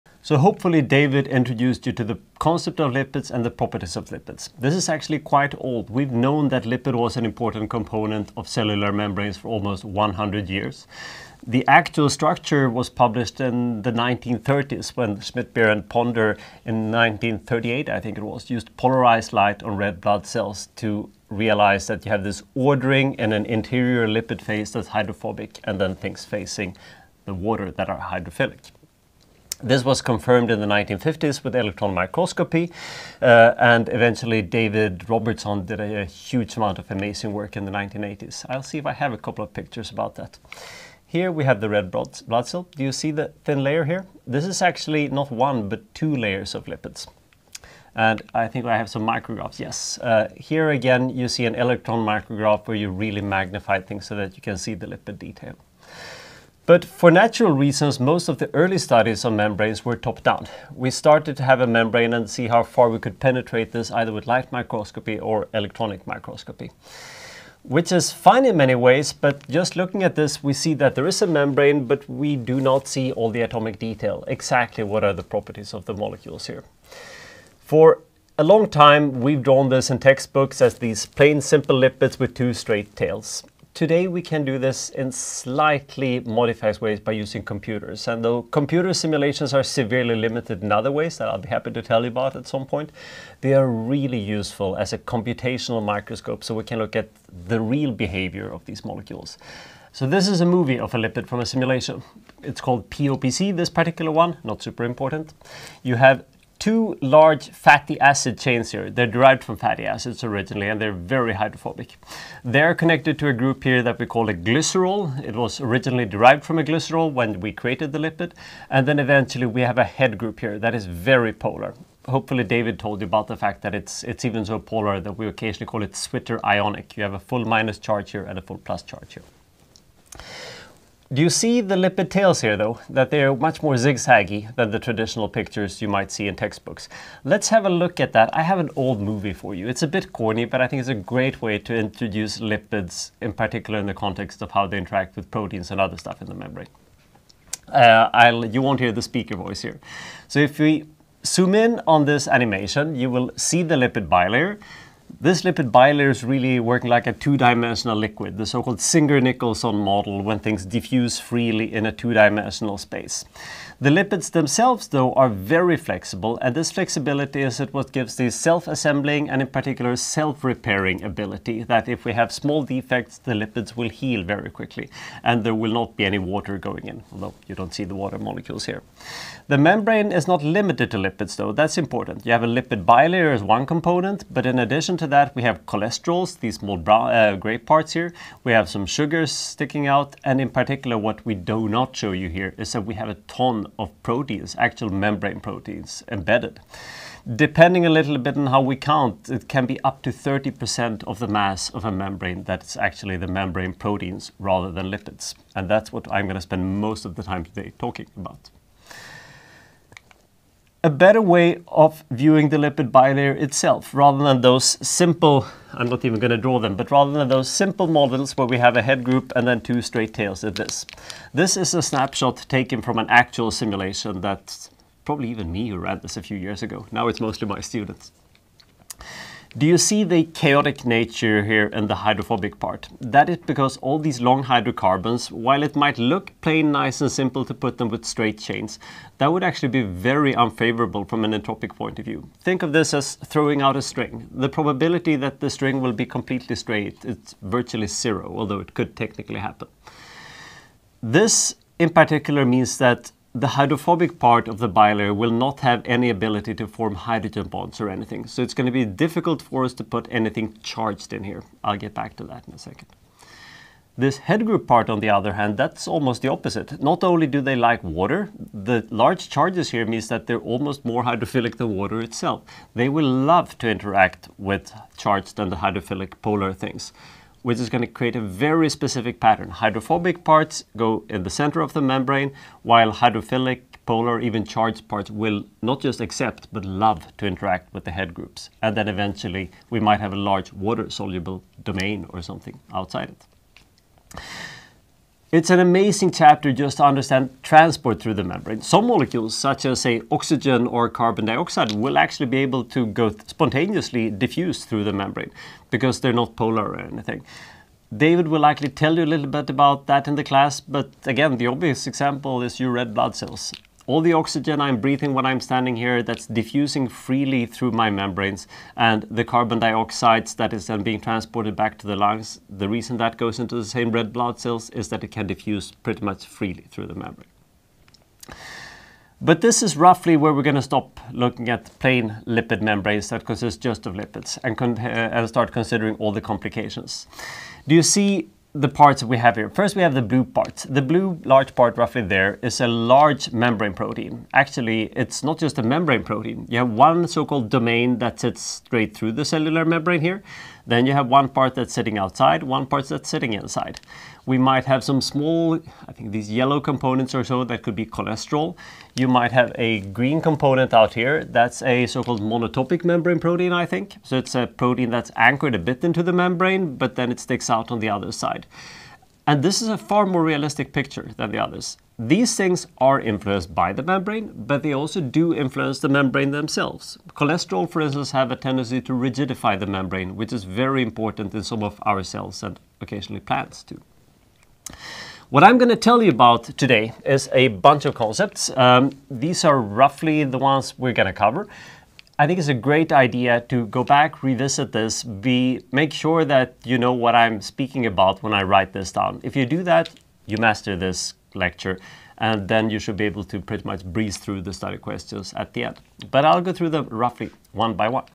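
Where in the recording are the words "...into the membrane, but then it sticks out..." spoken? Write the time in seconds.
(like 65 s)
365 s.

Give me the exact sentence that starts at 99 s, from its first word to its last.
So this is a movie of a lipid from a simulation.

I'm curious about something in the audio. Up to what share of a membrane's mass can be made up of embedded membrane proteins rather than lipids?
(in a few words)
30%.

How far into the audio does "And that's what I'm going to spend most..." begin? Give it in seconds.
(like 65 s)
205 s.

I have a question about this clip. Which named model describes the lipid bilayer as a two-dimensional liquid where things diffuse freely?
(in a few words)
Singer-Nicolson model.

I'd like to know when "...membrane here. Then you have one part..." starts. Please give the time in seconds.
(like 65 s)
349 s.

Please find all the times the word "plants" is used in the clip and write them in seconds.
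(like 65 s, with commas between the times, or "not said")
383 s.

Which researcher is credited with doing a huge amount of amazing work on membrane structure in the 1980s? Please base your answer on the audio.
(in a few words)
David Robertson.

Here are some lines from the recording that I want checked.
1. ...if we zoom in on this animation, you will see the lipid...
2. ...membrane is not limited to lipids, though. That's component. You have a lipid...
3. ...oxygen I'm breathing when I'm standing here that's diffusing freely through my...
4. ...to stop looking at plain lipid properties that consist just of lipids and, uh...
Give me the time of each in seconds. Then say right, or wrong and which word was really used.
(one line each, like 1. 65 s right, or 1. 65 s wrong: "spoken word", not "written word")
1. 150 s right
2. 179 s wrong: "important", not "component"
3. 314 s right
4. 330 s wrong: "membranes", not "properties".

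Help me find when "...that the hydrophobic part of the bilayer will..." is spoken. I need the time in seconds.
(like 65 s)
252 s.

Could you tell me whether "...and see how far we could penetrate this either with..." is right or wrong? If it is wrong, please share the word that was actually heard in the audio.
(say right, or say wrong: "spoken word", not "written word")
right.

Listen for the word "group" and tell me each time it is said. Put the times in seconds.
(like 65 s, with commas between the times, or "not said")
113 s, 120 s, 219 s, 264 s, 288 s.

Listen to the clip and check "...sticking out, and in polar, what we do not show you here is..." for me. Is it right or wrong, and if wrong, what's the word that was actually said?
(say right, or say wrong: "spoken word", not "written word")
wrong: "particular", not "polar".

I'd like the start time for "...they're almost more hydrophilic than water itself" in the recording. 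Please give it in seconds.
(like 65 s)
270 s.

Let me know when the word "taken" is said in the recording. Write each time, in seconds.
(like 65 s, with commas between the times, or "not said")
222 s.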